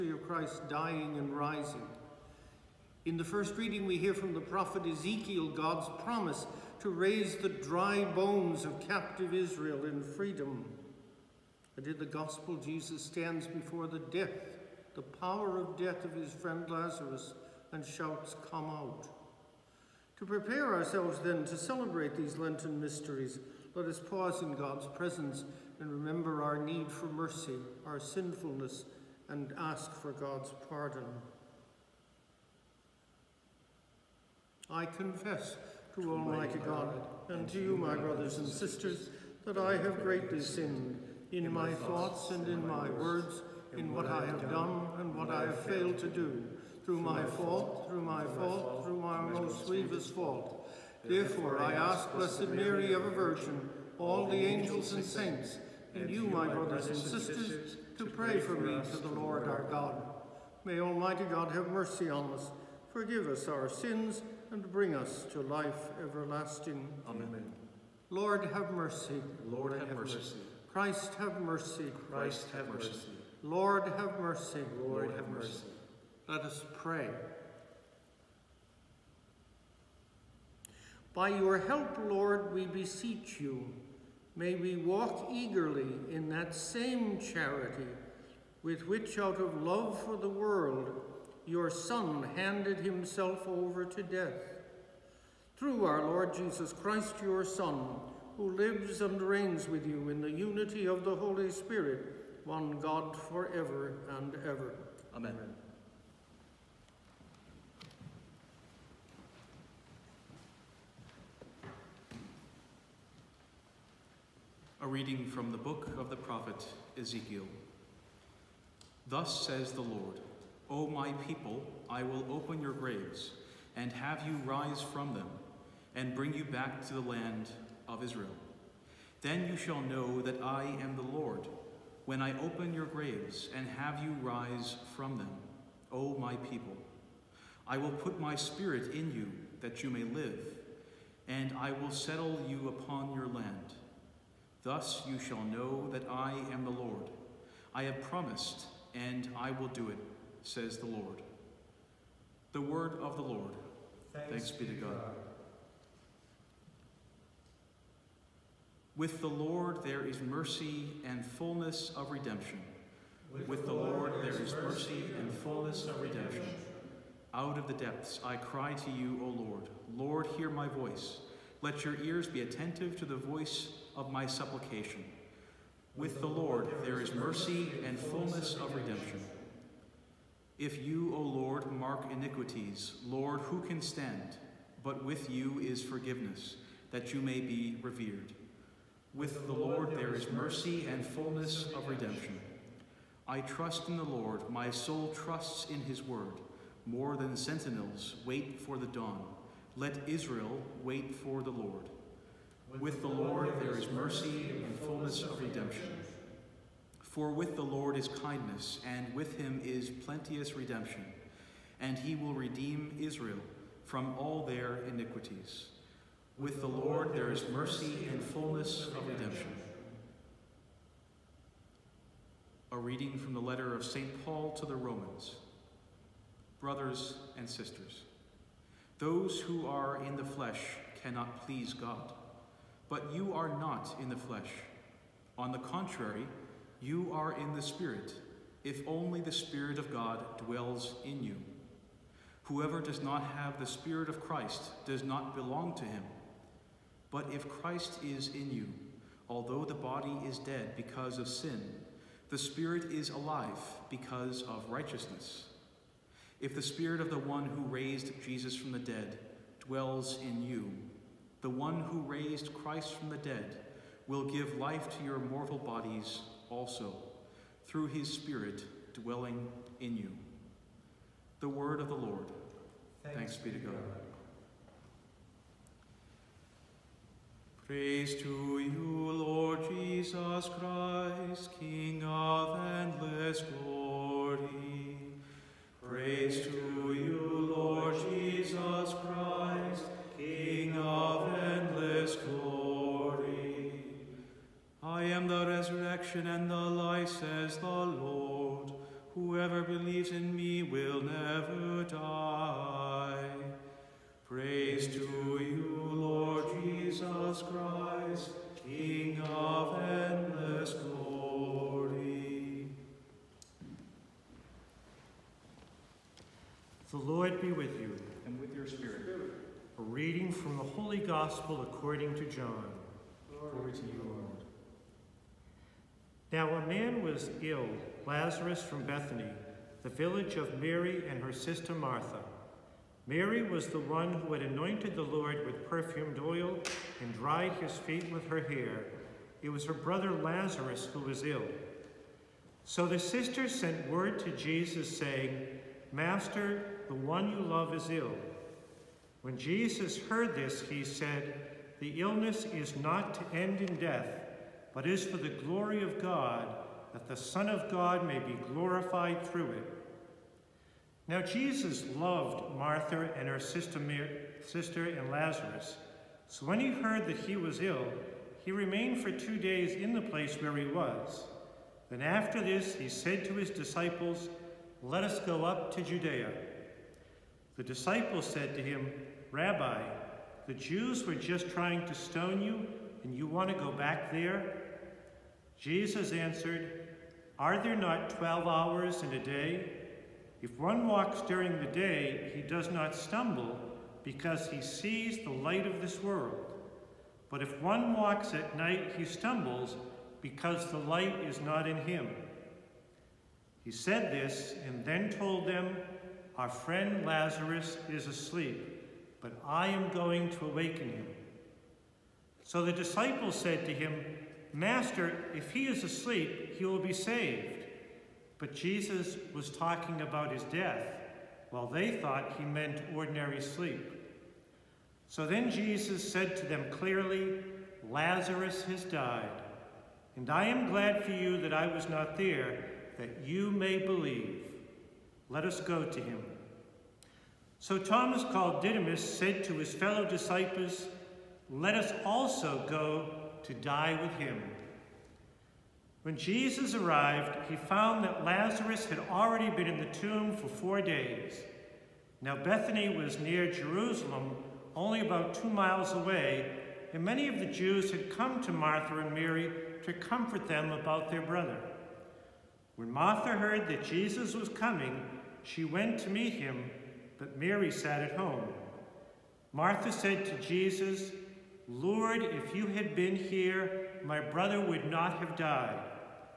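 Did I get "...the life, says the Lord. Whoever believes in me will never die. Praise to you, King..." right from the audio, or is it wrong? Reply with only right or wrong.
wrong.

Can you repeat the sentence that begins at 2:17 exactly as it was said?
I will put my spirit in you that you may live, and I will settle you upon your land.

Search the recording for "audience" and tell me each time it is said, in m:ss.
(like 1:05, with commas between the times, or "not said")
not said.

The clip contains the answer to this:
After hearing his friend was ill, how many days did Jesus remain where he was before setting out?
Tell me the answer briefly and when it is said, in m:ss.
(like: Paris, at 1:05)
2, at 6:09.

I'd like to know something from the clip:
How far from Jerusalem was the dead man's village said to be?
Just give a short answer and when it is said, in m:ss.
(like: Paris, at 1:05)
2 miles, at 7:35.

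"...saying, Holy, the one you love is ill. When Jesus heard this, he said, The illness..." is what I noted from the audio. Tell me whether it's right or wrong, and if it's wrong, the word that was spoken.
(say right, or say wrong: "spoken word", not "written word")
wrong: "Master", not "Holy".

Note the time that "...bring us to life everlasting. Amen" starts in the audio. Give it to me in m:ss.
1:04.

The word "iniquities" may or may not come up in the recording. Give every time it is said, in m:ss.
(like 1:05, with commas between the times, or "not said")
3:02, 3:34.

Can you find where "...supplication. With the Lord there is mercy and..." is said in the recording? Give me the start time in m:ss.
2:54.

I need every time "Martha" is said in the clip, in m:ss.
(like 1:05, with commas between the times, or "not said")
5:31, 6:02, 7:38, 7:42, 7:49.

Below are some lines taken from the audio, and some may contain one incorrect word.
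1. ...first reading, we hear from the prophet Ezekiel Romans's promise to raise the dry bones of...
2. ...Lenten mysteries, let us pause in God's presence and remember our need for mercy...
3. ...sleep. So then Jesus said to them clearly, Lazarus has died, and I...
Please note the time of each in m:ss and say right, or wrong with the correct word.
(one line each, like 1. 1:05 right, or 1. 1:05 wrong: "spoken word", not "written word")
1. 0:03 wrong: "God", not "Romans"
2. 0:22 right
3. 7:03 right.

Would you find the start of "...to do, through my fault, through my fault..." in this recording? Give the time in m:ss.
0:45.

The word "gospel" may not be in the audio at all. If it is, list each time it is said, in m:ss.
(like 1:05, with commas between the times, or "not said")
0:12, 5:20.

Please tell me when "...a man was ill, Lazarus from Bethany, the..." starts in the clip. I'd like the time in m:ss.
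5:26.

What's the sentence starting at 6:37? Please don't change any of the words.
But if one walks at night, he stumbles because the light is not in him.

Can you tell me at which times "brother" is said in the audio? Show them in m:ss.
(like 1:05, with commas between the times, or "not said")
0:37, 0:56, 3:46, 5:39, 7:41, 7:54.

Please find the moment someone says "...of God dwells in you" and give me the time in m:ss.
3:59.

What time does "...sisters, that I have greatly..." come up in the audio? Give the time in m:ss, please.
0:38.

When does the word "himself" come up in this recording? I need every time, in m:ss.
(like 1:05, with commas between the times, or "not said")
1:32.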